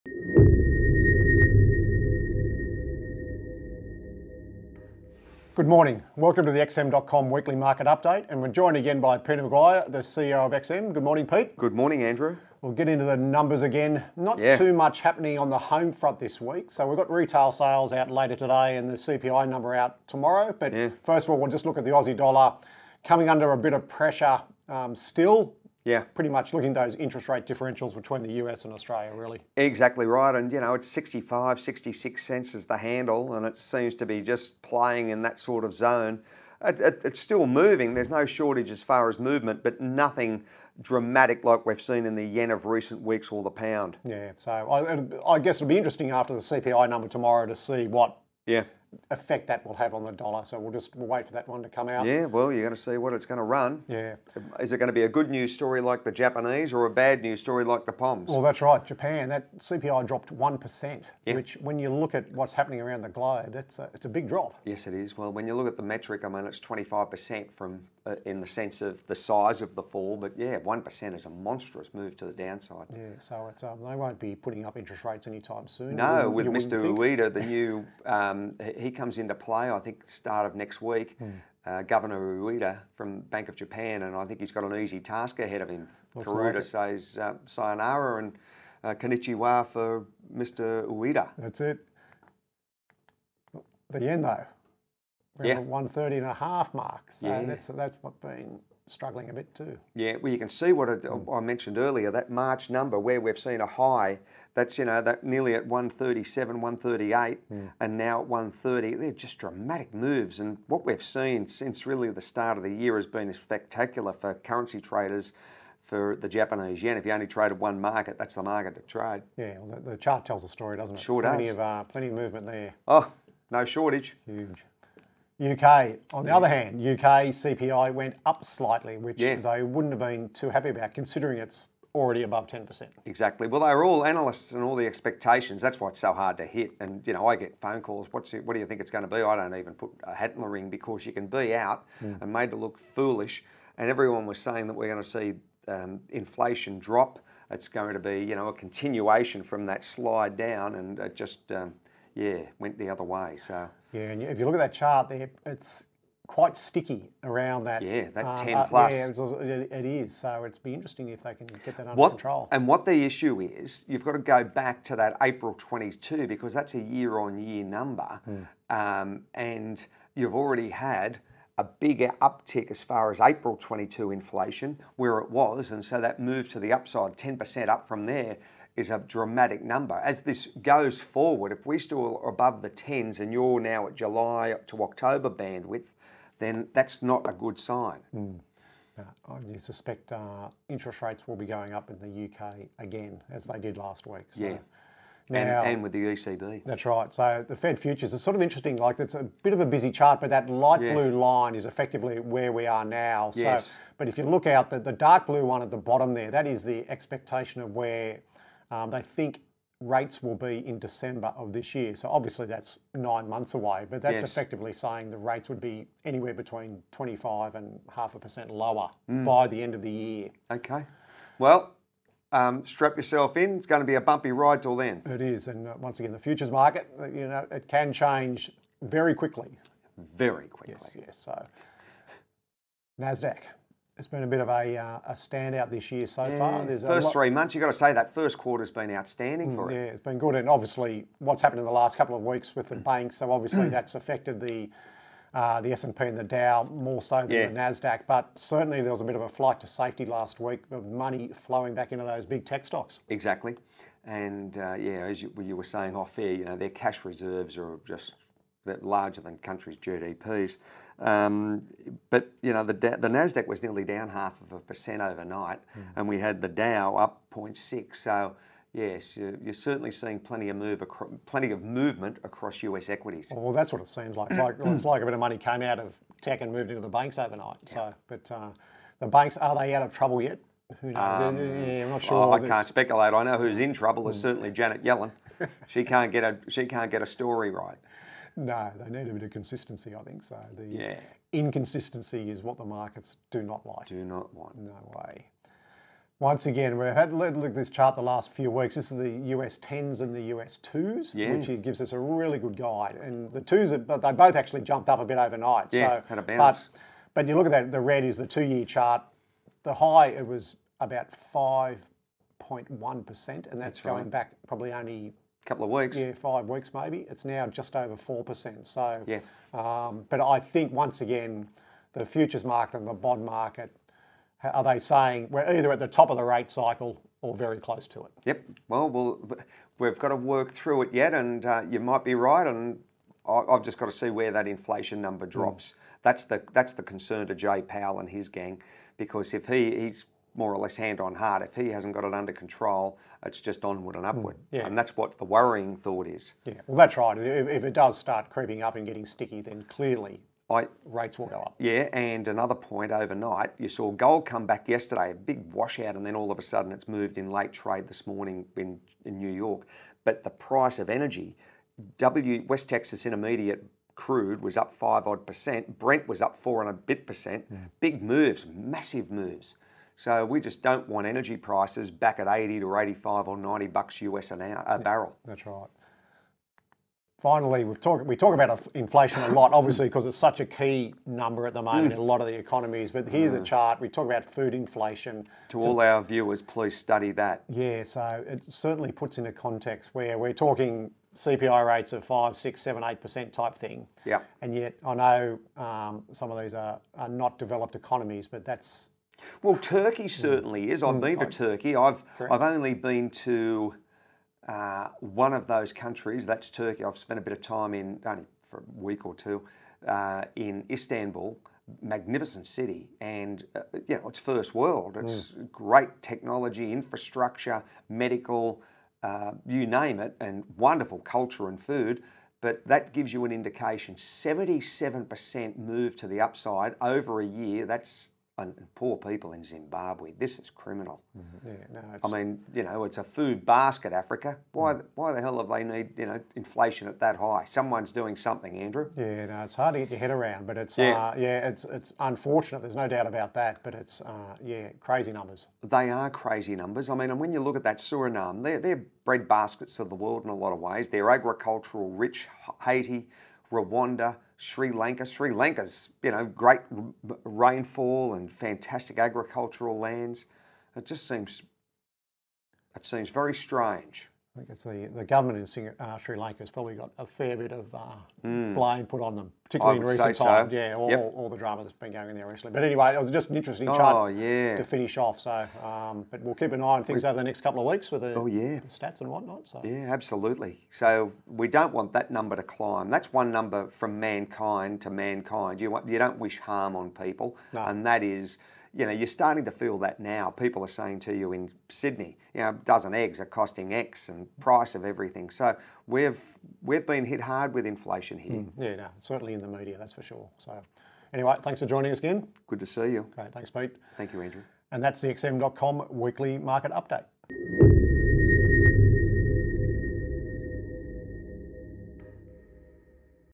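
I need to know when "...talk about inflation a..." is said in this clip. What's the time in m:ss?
6:18.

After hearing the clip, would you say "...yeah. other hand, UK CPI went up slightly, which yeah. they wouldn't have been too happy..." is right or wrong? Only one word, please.
right.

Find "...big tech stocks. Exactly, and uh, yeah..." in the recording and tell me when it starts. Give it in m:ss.
4:12.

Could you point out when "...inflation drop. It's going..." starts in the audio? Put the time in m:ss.
2:26.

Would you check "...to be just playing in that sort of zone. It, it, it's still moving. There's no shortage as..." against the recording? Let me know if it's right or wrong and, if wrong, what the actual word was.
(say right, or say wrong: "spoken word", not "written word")
right.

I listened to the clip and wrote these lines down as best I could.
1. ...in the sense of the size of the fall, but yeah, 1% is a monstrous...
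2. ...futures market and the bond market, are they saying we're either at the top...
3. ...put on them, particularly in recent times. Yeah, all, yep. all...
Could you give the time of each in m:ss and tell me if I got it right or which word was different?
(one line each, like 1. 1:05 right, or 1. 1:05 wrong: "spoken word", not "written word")
1. 1:08 right
2. 5:22 right
3. 7:48 right.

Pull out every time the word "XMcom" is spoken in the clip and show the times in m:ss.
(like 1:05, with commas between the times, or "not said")
0:06, 8:25.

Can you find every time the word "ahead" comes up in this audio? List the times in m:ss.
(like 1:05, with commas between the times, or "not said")
1:25.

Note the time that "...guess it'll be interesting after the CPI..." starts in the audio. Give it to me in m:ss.
0:45.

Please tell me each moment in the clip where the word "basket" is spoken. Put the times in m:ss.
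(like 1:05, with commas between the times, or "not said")
7:13, 7:29.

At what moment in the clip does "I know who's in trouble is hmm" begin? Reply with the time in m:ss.
4:43.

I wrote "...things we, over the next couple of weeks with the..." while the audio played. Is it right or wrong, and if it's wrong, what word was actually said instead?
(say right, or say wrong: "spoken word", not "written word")
right.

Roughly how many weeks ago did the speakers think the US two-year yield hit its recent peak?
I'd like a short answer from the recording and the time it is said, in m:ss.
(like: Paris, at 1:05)
5 weeks, at 5:16.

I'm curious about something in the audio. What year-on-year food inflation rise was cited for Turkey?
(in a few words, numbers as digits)
77%.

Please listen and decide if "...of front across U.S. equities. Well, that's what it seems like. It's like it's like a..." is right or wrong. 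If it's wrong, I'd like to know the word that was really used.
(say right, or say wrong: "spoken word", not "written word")
wrong: "movement", not "front".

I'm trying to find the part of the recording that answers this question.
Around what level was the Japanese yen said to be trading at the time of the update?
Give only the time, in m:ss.
1:35.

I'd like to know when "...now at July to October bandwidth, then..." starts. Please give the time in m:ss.
3:03.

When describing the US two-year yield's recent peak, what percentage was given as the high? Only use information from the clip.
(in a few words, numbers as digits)
5.1%.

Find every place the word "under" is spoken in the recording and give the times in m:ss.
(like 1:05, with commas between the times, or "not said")
0:23, 2:41, 5:42.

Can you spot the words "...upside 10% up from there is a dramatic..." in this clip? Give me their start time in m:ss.
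2:56.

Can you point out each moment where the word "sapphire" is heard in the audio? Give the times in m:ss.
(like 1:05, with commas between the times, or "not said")
not said.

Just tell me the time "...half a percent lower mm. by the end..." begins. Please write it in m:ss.
3:37.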